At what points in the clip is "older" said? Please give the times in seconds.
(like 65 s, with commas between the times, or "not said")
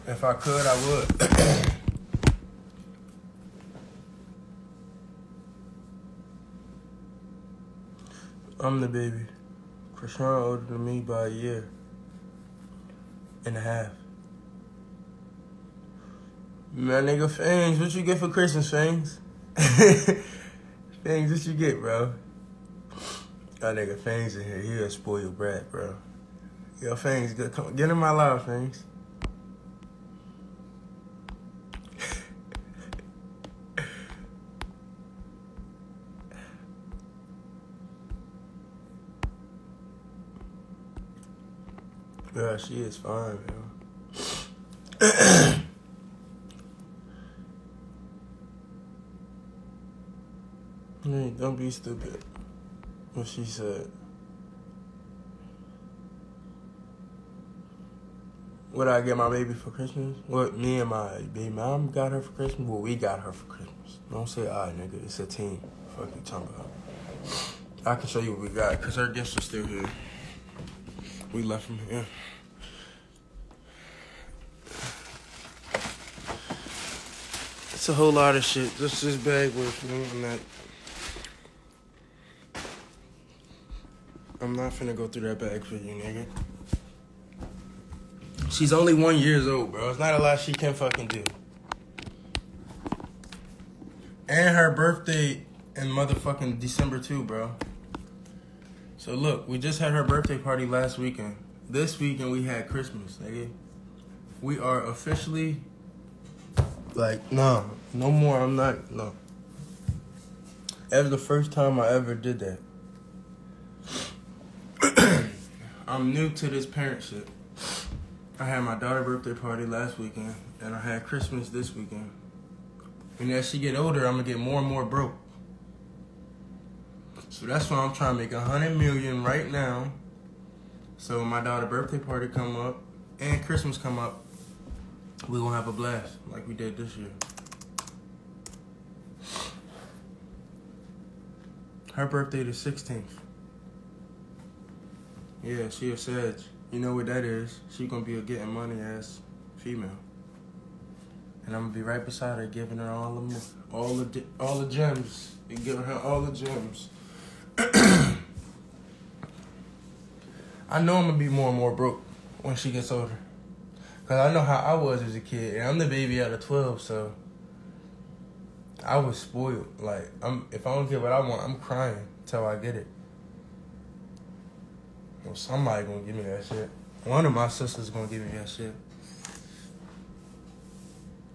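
10 s, 123 s, 162 s.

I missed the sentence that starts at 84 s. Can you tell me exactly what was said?
I'm not finna go through that bag for you, nigga.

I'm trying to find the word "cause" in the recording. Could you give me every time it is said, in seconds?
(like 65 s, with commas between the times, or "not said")
68 s, 164 s.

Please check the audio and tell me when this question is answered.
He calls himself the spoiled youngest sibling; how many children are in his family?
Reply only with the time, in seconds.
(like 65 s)
166 s.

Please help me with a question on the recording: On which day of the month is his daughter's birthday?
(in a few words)
16th.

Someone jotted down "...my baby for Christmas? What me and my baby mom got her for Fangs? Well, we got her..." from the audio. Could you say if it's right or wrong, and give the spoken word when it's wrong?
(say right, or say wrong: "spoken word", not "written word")
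wrong: "Christmas", not "Fangs".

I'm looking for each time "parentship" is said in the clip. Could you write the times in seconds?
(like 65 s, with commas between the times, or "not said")
116 s.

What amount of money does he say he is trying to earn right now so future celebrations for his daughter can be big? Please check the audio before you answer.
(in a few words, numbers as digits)
100 million.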